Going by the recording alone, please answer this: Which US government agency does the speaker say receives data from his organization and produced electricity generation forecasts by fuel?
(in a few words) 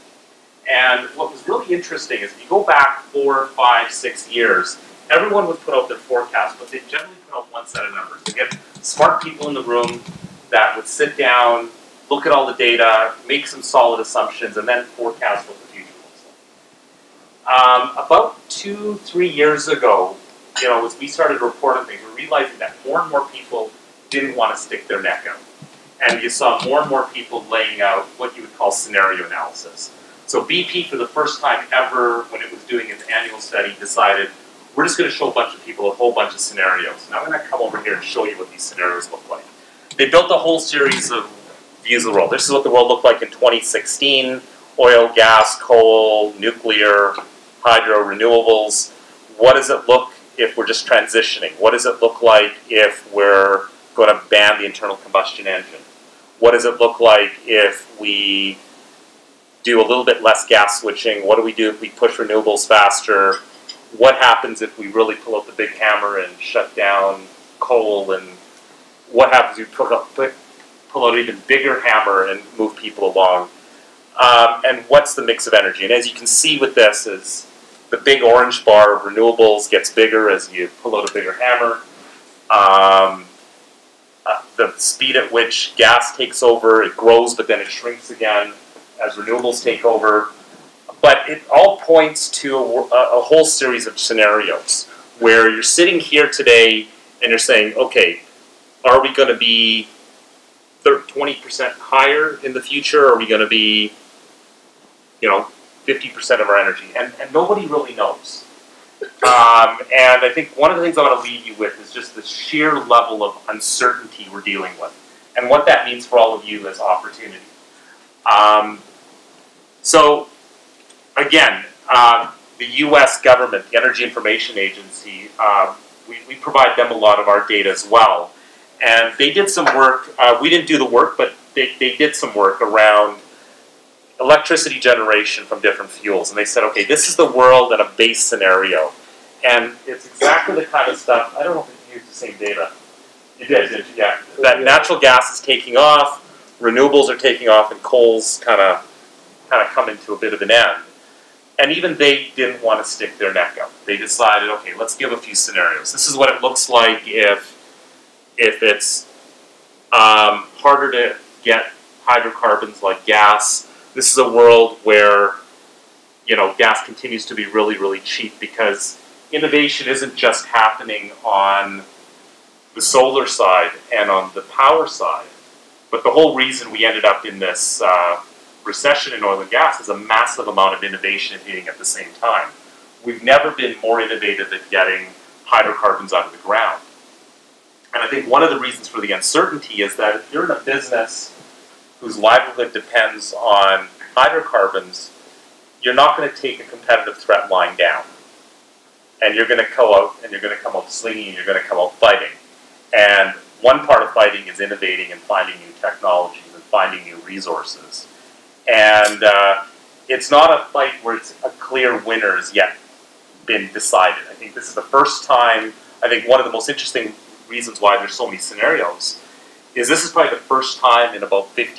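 Energy Information Agency.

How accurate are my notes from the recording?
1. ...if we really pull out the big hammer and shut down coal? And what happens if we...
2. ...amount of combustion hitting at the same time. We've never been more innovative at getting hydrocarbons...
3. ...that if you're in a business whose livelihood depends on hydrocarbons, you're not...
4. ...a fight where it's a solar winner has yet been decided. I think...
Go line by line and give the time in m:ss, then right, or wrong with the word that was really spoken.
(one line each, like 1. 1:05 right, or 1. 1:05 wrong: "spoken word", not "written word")
1. 1:04 right
2. 3:00 wrong: "innovation", not "combustion"
3. 3:09 right
4. 3:30 wrong: "clear", not "solar".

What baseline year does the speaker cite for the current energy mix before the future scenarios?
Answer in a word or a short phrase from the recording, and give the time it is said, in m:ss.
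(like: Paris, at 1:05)
2016, at 0:43.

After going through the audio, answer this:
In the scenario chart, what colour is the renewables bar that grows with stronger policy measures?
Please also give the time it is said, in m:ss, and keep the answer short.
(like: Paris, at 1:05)
Orange, at 1:18.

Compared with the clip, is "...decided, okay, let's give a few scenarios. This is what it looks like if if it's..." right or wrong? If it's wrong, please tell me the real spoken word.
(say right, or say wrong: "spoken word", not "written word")
right.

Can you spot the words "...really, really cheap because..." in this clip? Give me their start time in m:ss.
2:47.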